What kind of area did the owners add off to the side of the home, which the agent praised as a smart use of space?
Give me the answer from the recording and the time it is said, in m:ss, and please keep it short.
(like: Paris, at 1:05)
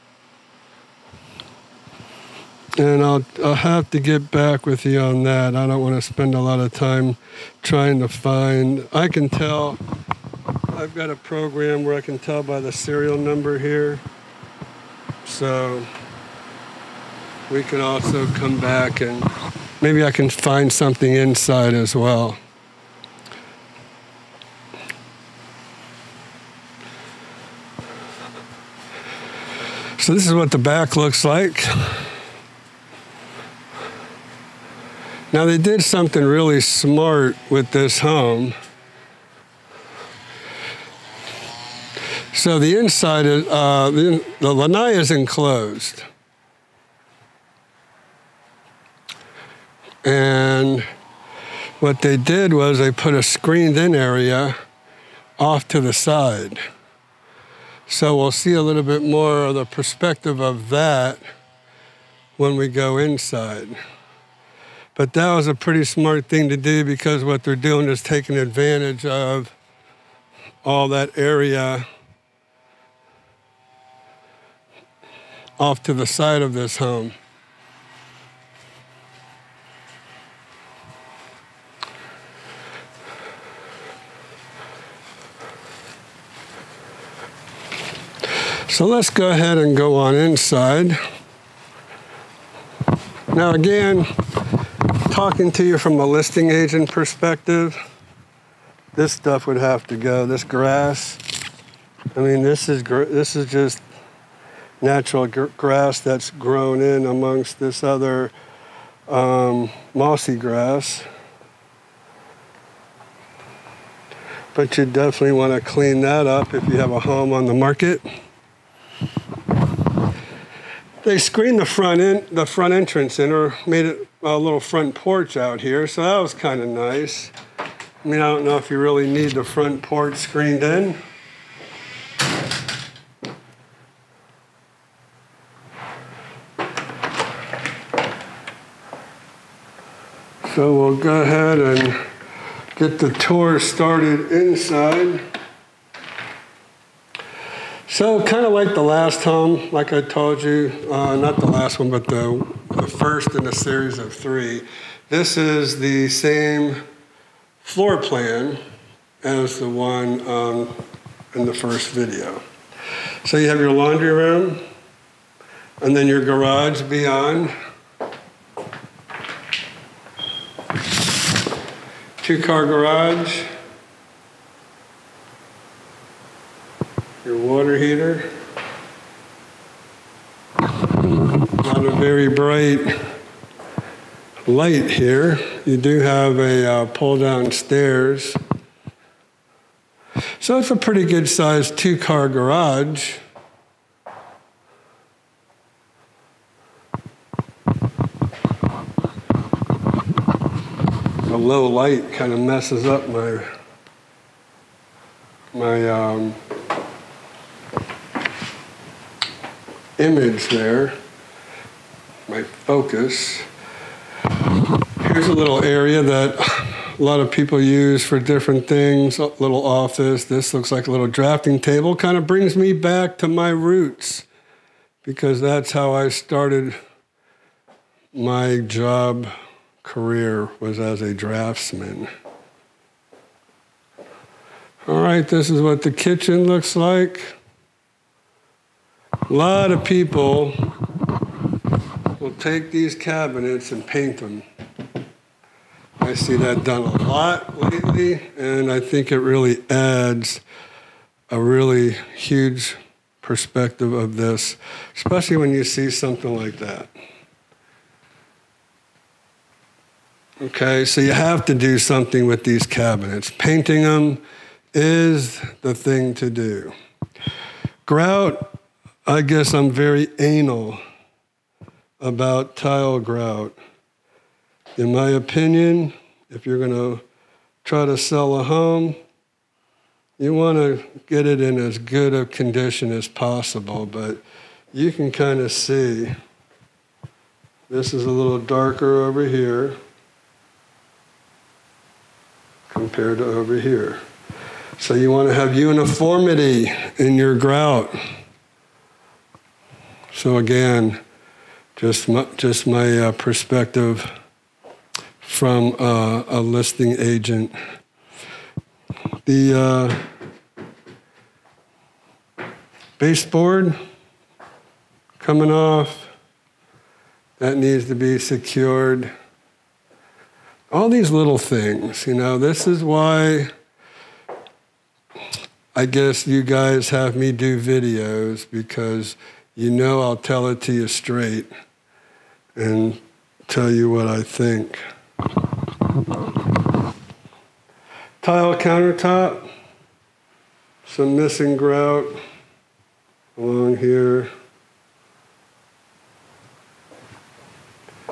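Screened in area, at 0:53.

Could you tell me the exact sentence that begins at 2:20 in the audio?
So we'll go ahead and get the tour started inside.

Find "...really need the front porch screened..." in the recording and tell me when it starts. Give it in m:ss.
2:08.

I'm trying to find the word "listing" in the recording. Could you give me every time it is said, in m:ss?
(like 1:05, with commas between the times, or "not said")
1:36, 5:06.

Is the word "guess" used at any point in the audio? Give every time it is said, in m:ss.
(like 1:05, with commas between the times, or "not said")
4:29, 5:25.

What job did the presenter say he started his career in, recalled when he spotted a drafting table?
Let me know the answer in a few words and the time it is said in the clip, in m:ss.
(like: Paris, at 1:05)
Draftsman, at 3:51.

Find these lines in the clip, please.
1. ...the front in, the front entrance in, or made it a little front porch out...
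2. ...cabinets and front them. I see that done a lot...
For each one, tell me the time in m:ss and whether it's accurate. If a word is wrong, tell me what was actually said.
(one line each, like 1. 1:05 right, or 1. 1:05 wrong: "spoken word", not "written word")
1. 2:01 right
2. 4:02 wrong: "paint", not "front".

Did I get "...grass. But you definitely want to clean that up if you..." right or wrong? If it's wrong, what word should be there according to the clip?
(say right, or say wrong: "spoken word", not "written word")
right.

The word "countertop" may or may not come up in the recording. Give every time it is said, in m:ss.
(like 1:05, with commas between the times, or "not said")
5:38.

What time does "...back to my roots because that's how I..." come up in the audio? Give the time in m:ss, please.
3:42.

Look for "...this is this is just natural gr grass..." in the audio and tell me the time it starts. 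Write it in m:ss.
1:42.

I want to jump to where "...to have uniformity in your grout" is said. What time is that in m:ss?
4:55.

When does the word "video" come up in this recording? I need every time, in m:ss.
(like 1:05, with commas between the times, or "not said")
2:41, 5:27.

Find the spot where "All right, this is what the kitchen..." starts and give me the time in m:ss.
3:54.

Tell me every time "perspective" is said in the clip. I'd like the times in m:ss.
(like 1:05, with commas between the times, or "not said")
0:59, 1:36, 4:13, 5:03.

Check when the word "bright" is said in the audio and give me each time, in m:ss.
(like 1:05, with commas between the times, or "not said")
3:02.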